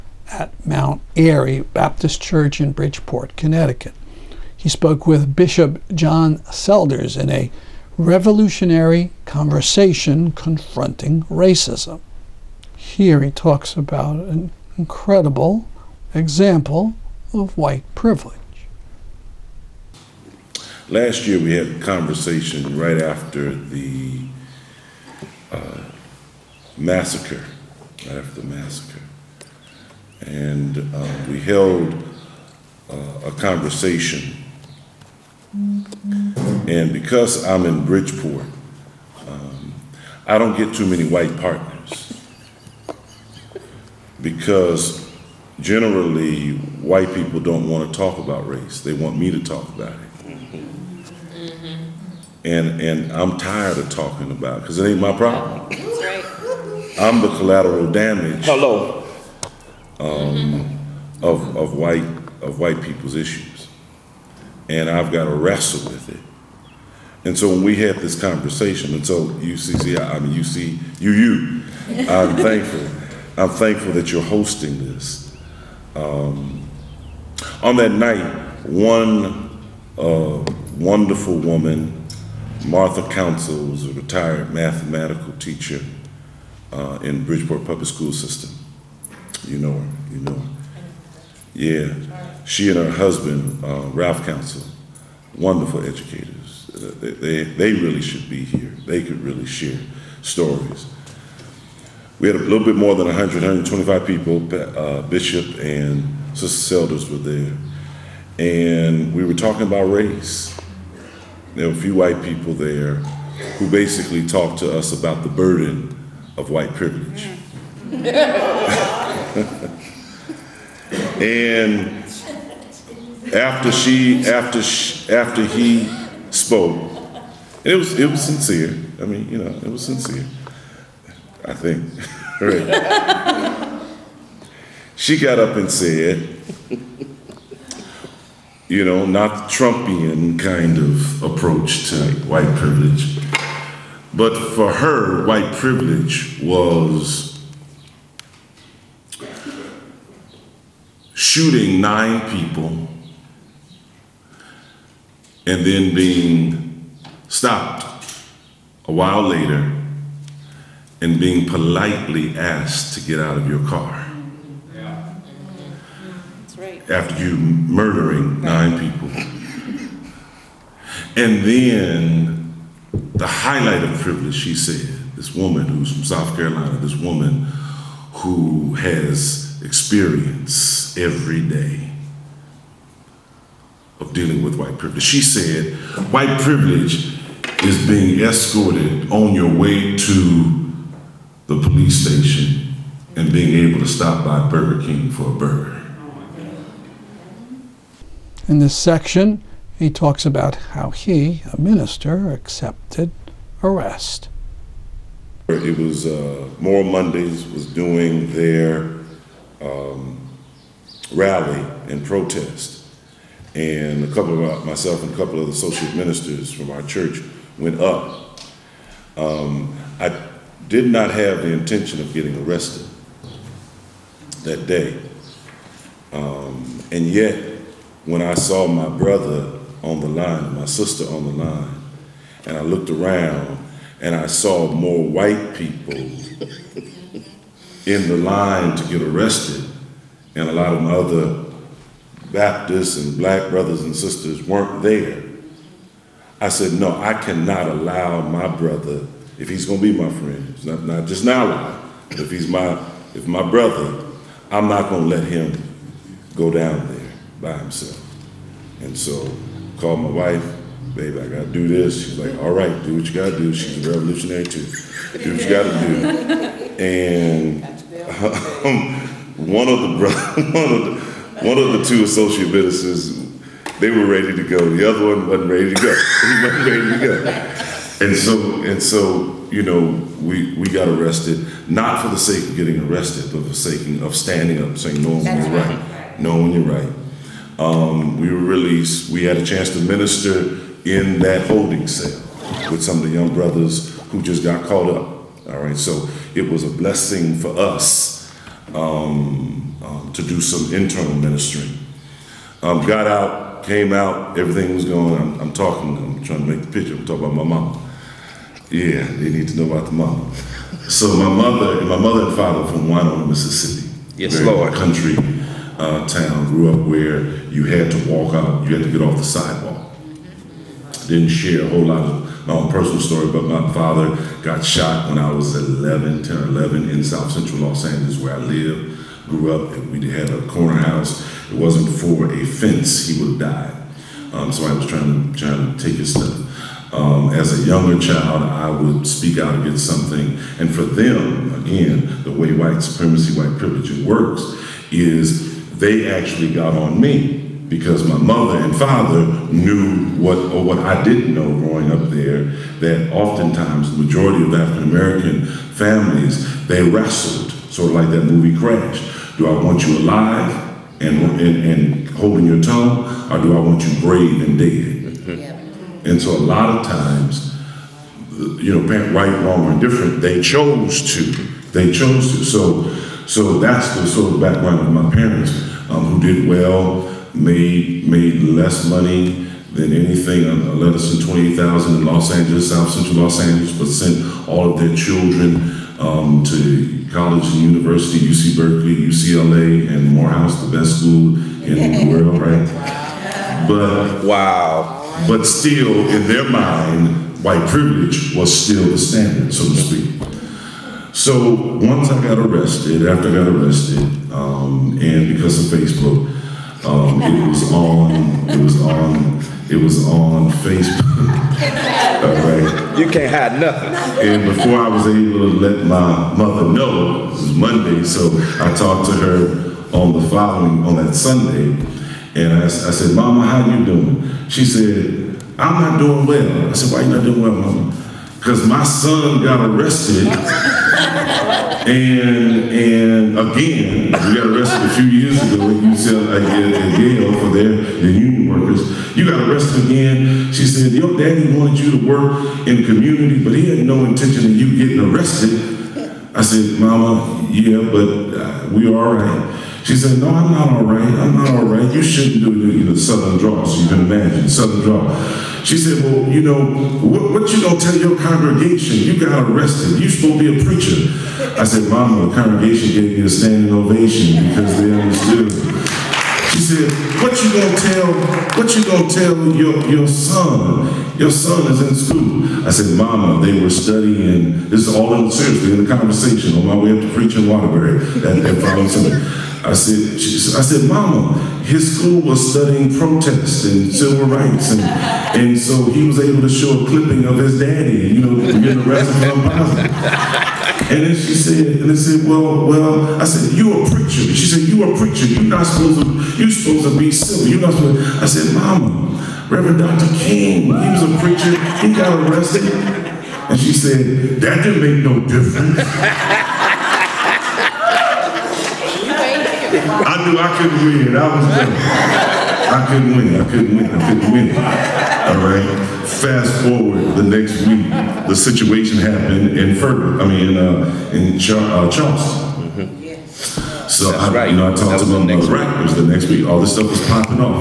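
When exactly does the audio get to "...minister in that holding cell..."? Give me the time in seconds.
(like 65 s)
289 s.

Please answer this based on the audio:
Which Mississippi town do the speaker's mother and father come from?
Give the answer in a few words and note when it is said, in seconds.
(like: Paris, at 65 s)
Winona, at 312 s.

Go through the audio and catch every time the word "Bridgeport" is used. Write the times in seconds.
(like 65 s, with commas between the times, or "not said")
2 s, 37 s, 87 s.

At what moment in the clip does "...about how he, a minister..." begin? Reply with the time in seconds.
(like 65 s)
200 s.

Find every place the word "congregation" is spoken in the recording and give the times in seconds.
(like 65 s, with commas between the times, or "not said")
458 s, 462 s.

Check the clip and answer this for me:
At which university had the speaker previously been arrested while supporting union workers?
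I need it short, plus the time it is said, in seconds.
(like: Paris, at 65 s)
Yale, at 437 s.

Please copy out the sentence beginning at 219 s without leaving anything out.
Um, I did not have the intention of getting arrested that day.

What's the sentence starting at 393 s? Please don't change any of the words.
But wow but still in their mind, white privilege was still the standard, so to speak.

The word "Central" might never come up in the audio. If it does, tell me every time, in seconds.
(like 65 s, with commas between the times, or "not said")
327 s, 382 s.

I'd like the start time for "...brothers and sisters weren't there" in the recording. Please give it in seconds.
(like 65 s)
243 s.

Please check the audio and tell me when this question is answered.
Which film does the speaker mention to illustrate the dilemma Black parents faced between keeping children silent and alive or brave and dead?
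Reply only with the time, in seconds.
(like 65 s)
358 s.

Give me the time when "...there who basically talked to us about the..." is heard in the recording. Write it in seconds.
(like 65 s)
112 s.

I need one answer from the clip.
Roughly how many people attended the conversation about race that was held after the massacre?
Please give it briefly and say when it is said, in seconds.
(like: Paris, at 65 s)
125, at 103 s.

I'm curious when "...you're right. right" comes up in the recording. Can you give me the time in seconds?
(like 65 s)
285 s.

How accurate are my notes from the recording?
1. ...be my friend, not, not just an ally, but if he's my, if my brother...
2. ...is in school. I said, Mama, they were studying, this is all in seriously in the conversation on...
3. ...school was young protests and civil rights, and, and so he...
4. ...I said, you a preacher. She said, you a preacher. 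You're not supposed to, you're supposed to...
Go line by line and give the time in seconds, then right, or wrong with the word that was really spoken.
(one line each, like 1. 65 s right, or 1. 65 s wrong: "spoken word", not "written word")
1. 249 s right
2. 471 s right
3. 481 s wrong: "studying", not "young"
4. 493 s right.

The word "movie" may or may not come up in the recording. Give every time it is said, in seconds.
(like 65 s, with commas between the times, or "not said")
358 s.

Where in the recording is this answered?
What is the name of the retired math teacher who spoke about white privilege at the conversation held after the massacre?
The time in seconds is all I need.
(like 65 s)
82 s.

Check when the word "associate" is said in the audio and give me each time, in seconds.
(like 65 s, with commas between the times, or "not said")
215 s, 272 s.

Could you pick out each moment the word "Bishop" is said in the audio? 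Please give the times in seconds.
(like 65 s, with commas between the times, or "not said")
5 s, 105 s.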